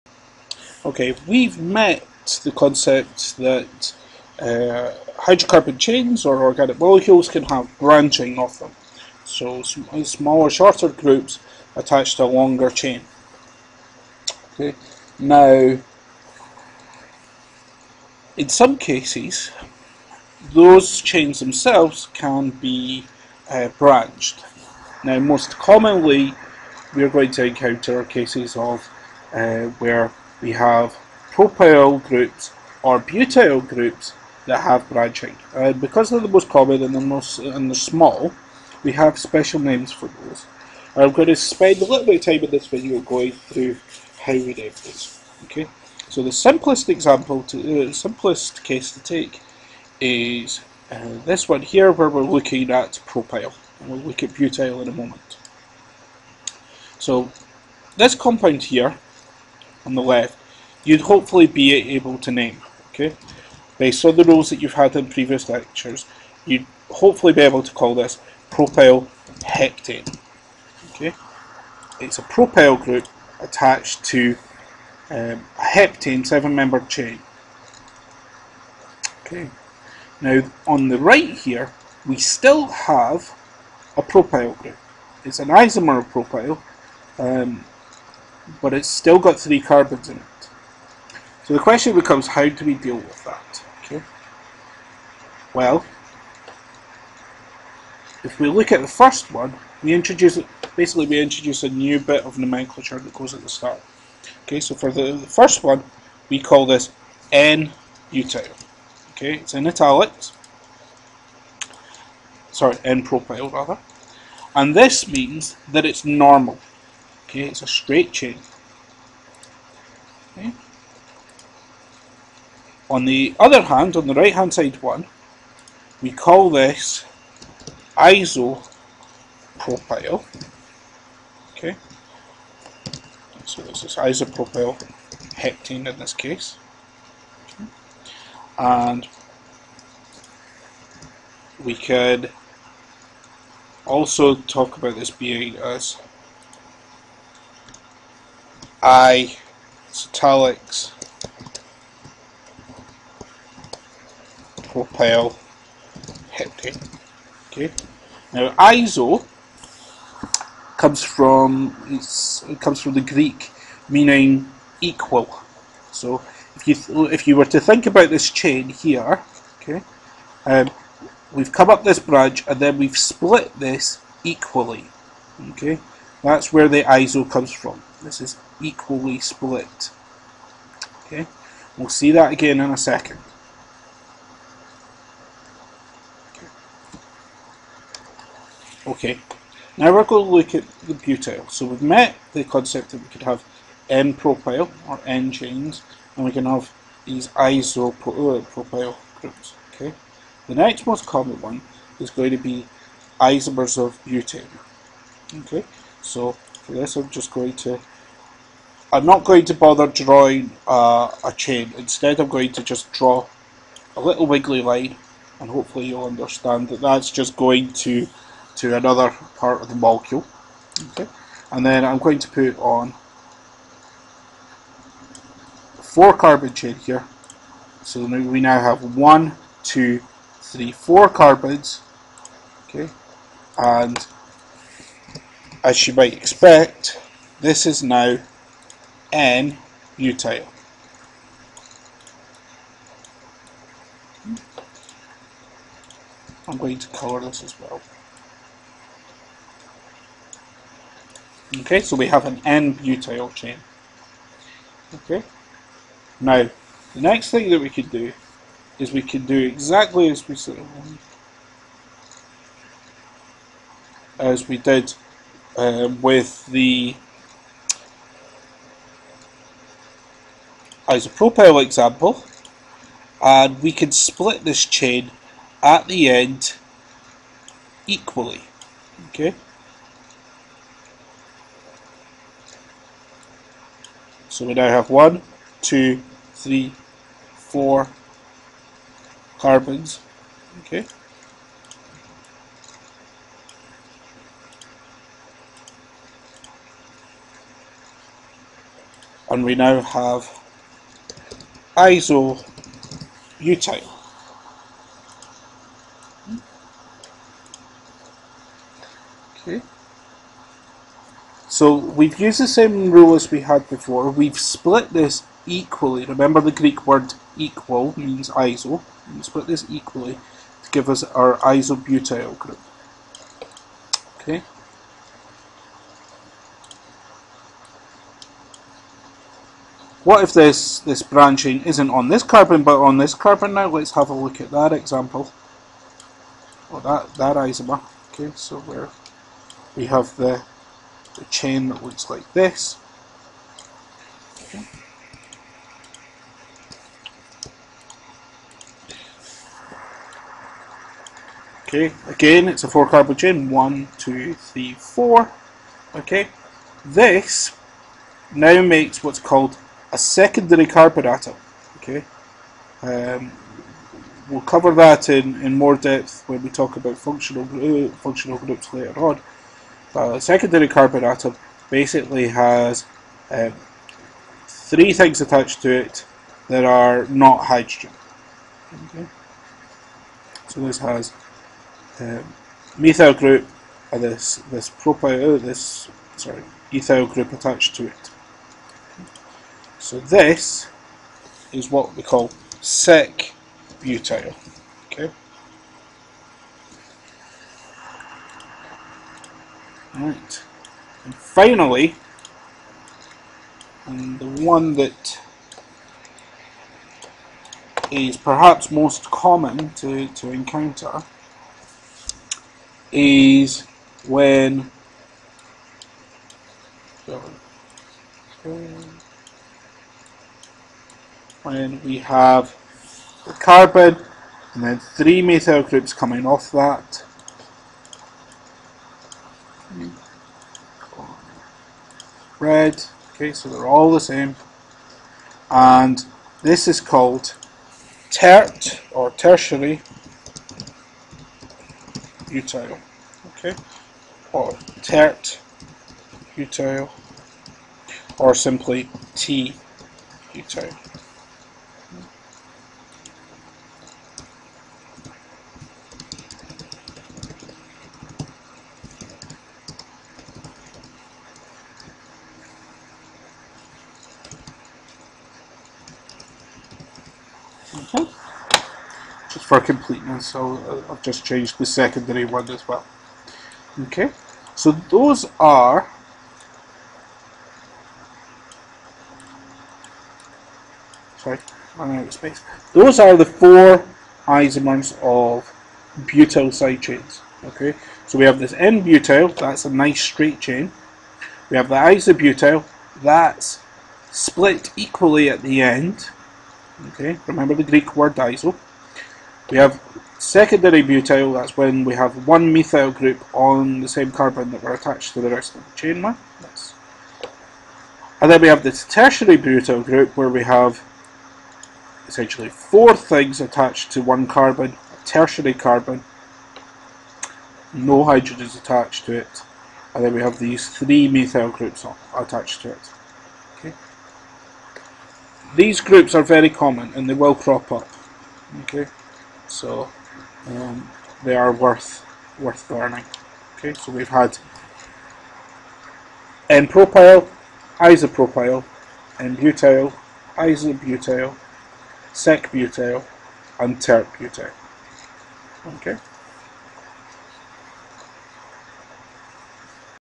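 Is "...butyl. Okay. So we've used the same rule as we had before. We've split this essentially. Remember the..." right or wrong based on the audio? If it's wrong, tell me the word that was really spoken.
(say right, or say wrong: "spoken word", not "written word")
wrong: "equally", not "essentially".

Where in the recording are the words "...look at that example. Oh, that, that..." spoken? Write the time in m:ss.
5:34.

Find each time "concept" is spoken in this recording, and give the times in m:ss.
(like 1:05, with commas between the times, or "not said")
0:02, 3:12.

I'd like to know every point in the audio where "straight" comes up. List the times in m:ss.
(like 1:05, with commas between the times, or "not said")
1:57, 8:10.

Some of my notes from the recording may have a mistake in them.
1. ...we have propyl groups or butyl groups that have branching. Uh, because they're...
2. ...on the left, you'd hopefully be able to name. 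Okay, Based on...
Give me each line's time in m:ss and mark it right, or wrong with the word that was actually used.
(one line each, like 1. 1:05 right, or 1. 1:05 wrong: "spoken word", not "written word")
1. 0:30 right
2. 0:59 right.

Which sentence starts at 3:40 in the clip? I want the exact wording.
Okay, And then I'm going to put on four carbon chain here.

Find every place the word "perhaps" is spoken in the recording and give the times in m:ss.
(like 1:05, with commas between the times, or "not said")
6:48.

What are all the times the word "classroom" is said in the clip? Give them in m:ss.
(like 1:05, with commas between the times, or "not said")
not said.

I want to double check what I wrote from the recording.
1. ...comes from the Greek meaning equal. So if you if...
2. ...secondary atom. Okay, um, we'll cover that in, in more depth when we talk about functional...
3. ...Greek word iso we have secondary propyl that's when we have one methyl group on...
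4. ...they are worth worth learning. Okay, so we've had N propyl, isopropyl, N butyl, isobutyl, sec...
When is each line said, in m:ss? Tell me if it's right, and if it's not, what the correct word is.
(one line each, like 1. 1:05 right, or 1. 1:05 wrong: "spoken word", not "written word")
1. 2:42 right
2. 5:59 right
3. 8:17 wrong: "butyl", not "propyl"
4. 8:51 right.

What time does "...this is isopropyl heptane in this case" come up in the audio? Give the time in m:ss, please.
2:13.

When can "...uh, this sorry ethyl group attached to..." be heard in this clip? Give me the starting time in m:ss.
6:25.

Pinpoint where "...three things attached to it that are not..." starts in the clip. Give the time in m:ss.
6:14.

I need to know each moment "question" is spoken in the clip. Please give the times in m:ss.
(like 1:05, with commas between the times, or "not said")
1:31.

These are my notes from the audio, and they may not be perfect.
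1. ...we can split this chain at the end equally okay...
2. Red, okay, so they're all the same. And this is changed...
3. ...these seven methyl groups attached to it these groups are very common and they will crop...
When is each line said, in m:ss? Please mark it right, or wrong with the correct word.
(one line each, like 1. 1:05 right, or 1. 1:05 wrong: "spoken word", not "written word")
1. 4:33 right
2. 7:12 wrong: "called", not "changed"
3. 8:40 wrong: "three", not "seven".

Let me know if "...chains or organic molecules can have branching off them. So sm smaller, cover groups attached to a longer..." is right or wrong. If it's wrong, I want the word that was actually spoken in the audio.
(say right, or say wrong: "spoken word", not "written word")
wrong: "shorter", not "cover".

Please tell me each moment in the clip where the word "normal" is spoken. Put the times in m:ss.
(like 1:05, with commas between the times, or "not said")
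1:56.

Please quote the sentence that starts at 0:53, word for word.
And we'll look at butyl in a moment.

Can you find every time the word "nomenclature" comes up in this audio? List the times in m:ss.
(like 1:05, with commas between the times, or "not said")
1:42.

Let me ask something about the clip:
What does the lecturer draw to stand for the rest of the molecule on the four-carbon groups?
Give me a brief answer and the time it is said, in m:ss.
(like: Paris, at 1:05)
a little wiggly line, at 3:34.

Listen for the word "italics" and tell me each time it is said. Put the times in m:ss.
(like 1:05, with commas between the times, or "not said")
1:49, 2:29.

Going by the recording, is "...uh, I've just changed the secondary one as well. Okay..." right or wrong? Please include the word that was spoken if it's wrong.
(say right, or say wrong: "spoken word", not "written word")
right.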